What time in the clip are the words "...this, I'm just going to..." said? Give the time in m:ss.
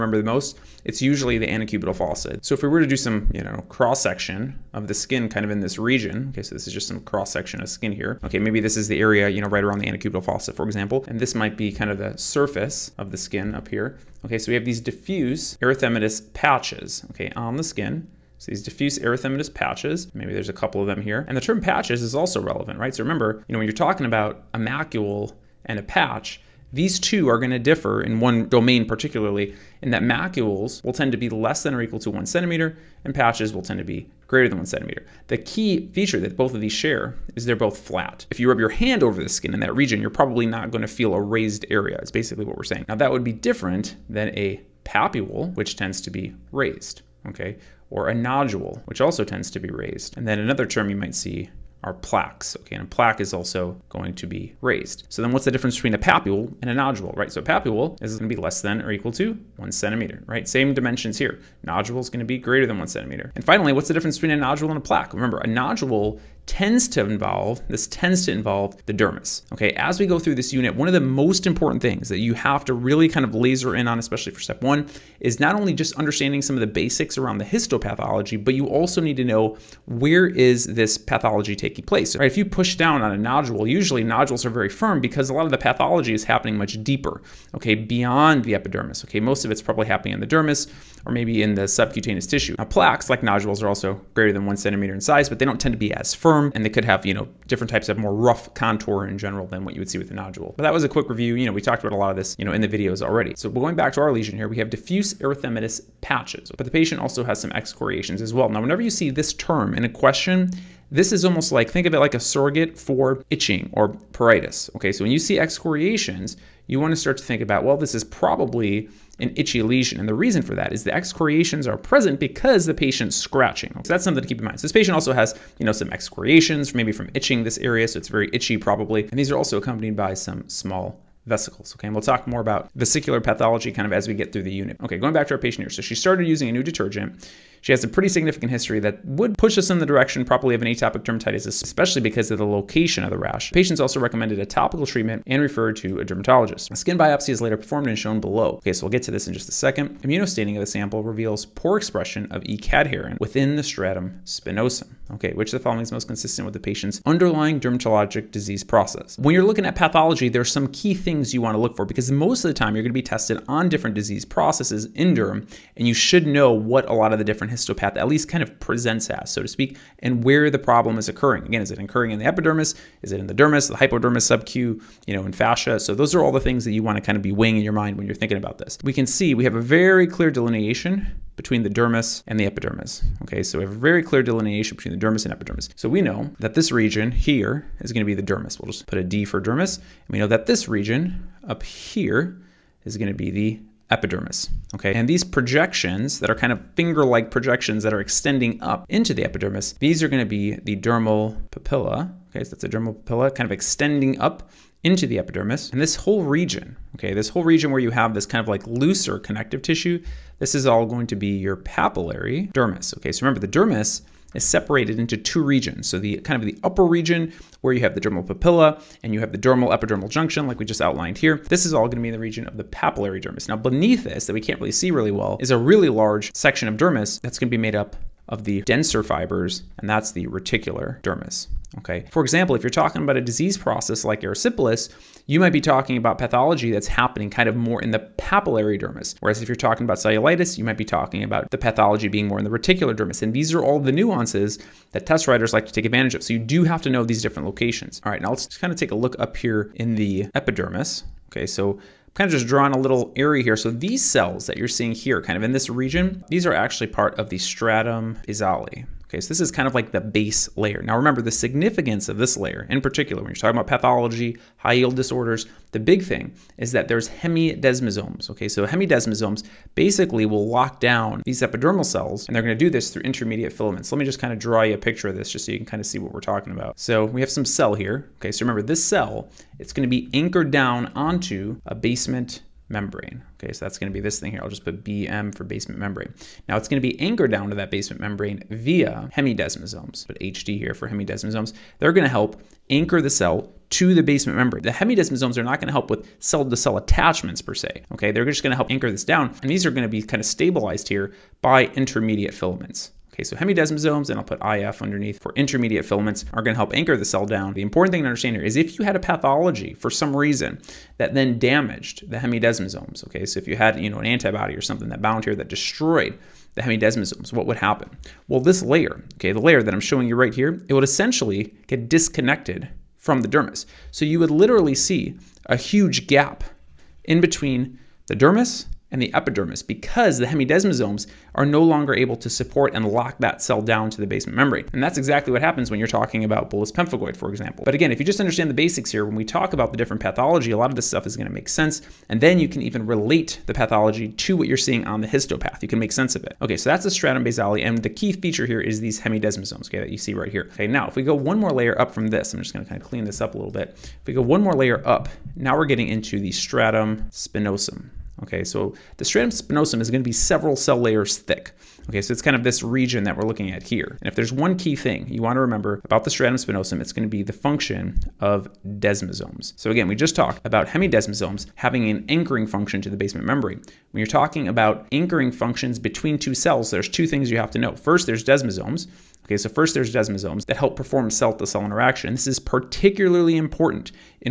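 5:52.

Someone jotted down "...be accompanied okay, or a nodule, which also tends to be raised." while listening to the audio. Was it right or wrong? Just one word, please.
wrong.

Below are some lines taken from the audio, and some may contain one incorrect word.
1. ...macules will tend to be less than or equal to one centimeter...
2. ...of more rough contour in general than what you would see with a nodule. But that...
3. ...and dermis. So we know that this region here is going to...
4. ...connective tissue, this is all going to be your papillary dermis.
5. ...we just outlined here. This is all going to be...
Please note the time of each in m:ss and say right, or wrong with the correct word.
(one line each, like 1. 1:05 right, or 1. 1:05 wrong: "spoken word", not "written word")
1. 0:30 right
2. 1:37 right
3. 3:05 wrong: "epidermis", not "dermis"
4. 3:29 right
5. 3:40 right.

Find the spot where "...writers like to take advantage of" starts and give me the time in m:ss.
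4:05.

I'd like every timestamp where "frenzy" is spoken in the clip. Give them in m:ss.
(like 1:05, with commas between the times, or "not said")
not said.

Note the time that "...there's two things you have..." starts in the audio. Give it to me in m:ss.
6:16.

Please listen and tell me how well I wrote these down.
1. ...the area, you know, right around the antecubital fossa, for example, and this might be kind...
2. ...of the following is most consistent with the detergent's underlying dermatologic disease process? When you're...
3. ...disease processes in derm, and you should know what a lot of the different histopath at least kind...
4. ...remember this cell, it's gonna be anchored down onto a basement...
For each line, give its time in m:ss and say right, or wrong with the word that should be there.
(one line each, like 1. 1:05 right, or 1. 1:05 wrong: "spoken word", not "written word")
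1. 0:08 right
2. 2:35 wrong: "patient", not "detergent"
3. 2:43 right
4. 4:38 right.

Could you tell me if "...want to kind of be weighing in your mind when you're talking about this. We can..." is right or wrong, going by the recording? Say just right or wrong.
wrong.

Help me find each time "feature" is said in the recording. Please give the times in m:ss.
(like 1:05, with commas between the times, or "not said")
0:35, 5:48.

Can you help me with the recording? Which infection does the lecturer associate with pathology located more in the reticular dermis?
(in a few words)
Cellulitis.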